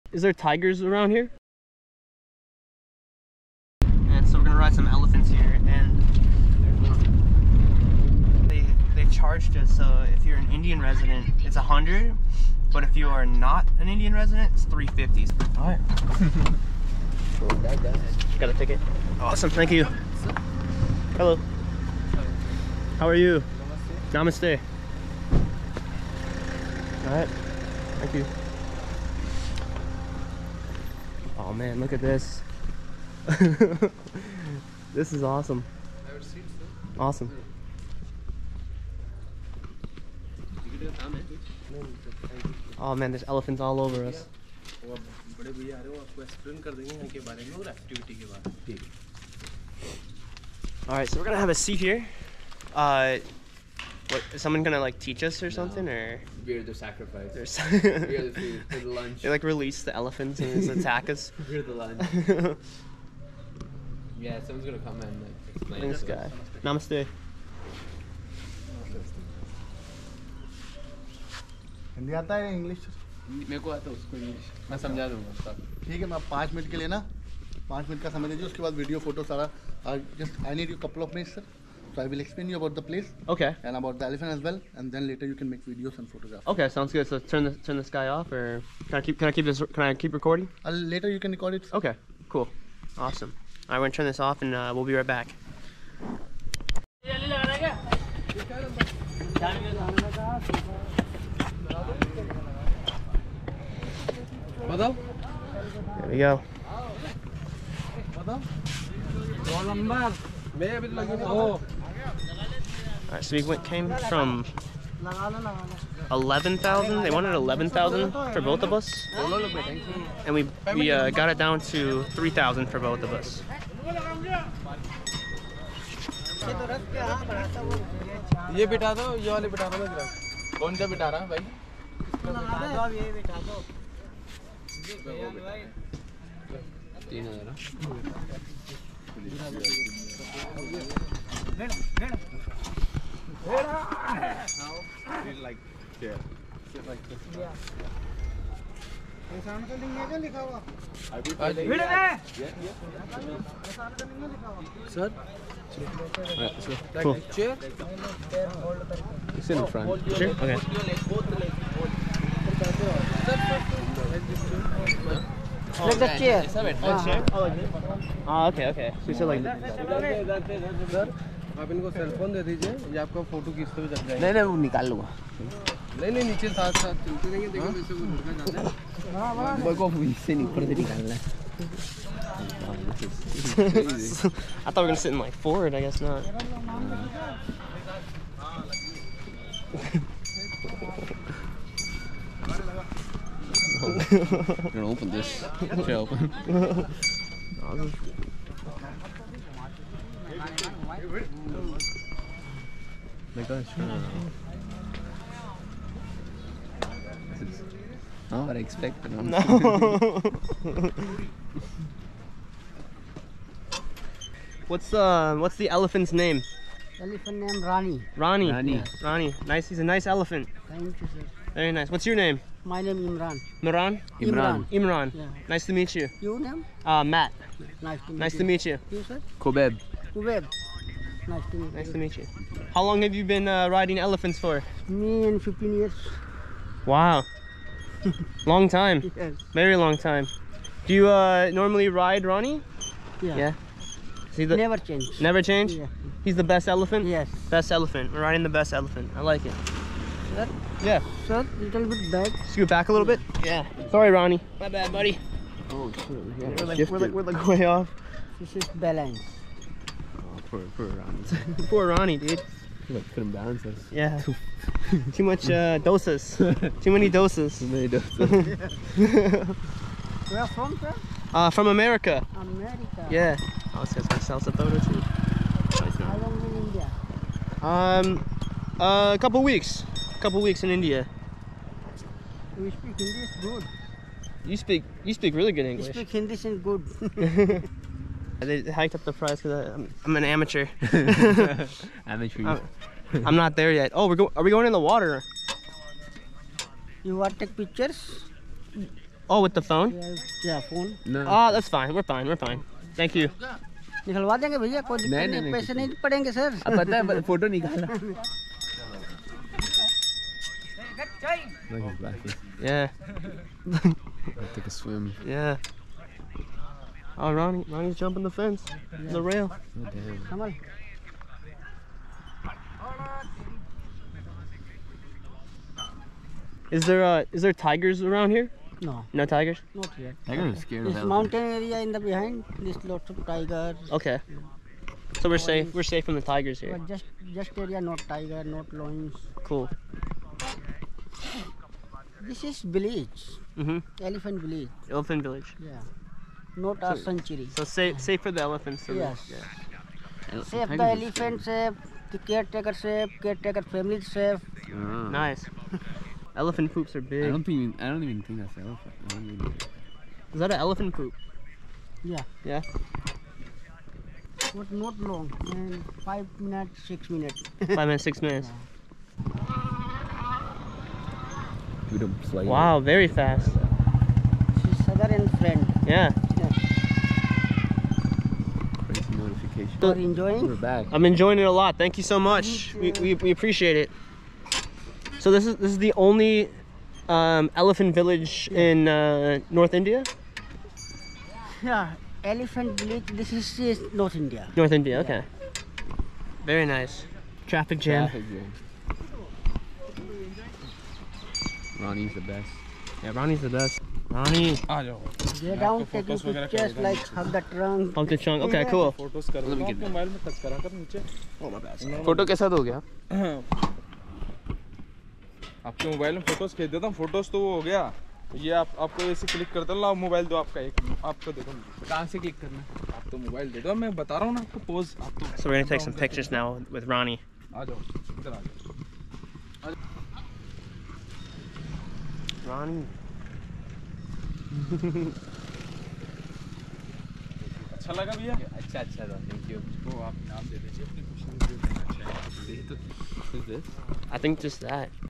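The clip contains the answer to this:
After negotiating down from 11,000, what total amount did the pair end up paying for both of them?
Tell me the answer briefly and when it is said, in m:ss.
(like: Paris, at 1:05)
3,000, at 2:02.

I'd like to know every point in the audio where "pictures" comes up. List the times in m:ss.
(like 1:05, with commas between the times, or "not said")
4:57, 7:06.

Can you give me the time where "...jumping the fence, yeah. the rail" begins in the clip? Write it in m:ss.
5:17.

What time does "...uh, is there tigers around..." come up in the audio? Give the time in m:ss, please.
5:27.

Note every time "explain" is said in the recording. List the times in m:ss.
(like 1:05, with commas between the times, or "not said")
1:05, 1:22.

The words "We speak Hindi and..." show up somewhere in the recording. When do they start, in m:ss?
4:45.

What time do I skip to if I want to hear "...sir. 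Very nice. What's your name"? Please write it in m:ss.
3:41.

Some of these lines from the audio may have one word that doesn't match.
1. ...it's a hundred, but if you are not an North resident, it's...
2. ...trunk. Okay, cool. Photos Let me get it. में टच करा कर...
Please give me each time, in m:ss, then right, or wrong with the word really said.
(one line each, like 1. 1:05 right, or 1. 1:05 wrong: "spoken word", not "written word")
1. 0:11 wrong: "Indian", not "North"
2. 6:48 right.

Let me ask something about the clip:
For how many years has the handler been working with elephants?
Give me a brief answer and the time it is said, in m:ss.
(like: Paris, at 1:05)
15, at 3:55.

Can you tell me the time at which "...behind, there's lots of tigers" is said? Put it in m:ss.
5:31.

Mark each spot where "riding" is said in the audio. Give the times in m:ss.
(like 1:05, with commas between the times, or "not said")
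3:53, 4:08.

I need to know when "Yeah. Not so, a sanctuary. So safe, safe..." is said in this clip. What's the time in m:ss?
5:45.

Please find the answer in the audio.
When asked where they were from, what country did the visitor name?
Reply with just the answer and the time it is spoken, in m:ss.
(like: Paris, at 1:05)
America, at 4:31.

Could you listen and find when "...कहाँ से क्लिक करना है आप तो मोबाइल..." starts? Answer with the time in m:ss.
7:01.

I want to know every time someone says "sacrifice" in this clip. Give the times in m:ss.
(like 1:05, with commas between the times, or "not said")
0:56.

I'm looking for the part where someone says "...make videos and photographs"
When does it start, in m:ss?
1:25.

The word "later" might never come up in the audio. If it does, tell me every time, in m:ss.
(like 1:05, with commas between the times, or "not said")
1:25, 1:30.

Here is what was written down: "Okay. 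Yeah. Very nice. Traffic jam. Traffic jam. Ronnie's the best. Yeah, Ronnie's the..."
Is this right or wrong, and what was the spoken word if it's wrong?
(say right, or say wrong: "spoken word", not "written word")
right.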